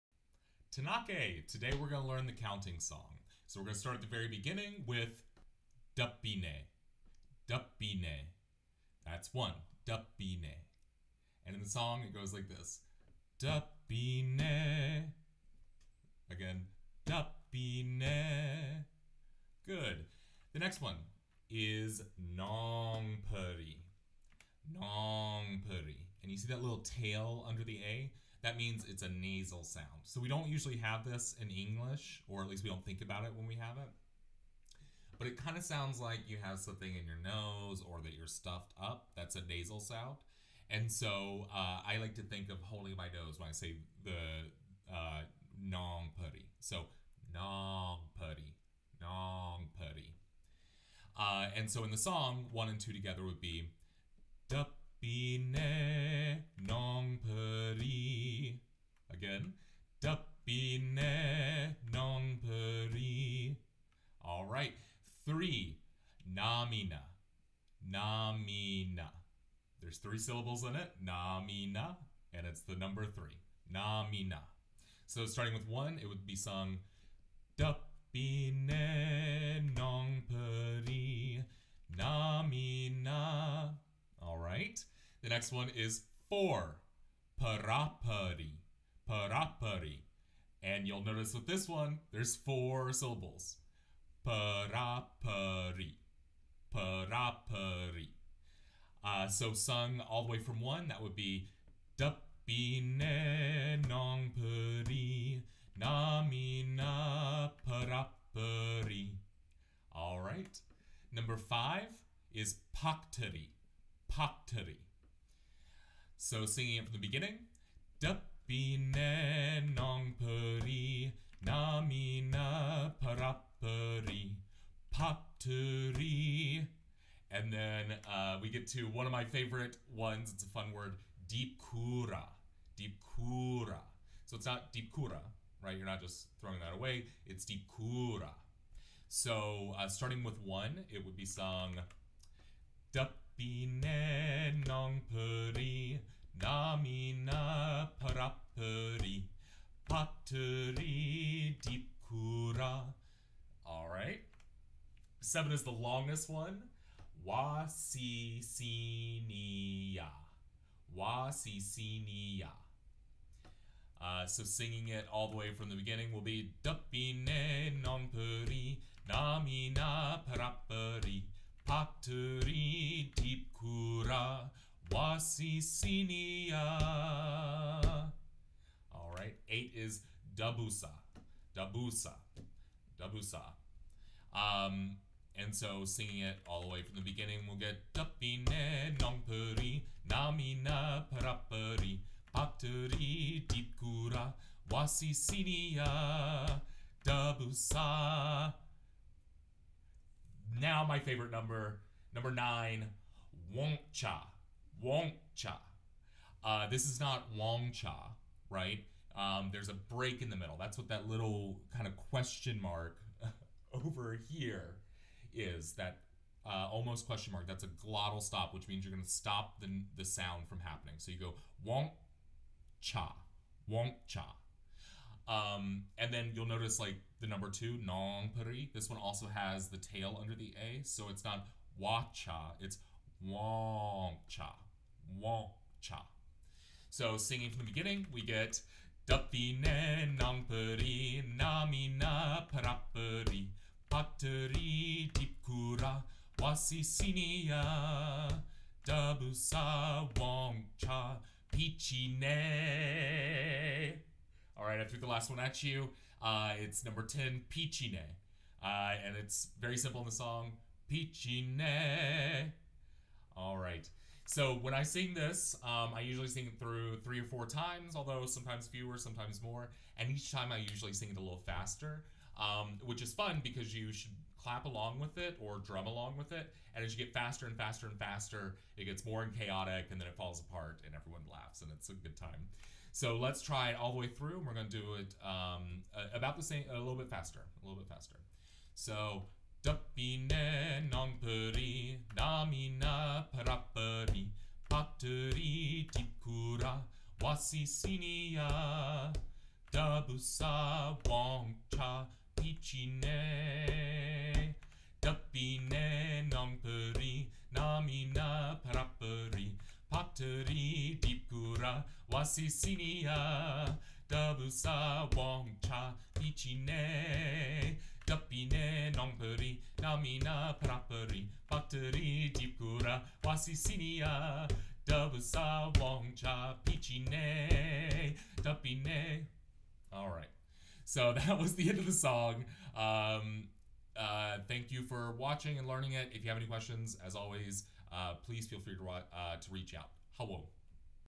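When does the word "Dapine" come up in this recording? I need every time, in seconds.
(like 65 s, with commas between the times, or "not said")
59 s, 77 s, 101 s, 117 s, 166 s, 187 s, 239 s.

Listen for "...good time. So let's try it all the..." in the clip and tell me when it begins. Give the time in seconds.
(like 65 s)
281 s.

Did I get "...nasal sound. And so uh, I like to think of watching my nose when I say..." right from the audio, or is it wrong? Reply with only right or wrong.
wrong.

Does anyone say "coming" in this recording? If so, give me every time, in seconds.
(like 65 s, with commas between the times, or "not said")
not said.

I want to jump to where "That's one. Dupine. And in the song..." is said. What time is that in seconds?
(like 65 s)
9 s.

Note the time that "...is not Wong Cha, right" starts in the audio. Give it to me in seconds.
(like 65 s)
206 s.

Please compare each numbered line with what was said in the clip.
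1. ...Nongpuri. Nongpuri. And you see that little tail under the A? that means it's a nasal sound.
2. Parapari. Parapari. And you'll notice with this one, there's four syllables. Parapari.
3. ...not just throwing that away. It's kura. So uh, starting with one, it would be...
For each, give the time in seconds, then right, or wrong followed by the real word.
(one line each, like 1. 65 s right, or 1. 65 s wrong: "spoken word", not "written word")
1. 22 s right
2. 87 s right
3. 135 s right.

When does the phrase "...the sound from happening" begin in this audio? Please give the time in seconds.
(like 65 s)
219 s.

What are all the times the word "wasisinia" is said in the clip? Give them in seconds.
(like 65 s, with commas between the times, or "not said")
174 s, 194 s, 246 s, 297 s, 312 s.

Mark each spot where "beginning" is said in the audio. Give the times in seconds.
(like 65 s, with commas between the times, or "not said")
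4 s, 116 s, 165 s, 187 s, 237 s.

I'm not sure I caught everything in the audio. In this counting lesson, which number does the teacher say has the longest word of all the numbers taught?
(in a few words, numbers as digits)
7.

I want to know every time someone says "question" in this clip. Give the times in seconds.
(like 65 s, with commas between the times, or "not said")
211 s, 217 s, 336 s.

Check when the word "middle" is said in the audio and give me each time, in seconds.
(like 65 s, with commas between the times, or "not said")
210 s.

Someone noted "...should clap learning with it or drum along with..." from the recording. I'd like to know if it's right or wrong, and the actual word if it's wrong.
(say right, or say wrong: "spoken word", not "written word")
wrong: "along", not "learning".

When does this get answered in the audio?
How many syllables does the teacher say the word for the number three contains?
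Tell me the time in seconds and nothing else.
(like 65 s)
69 s.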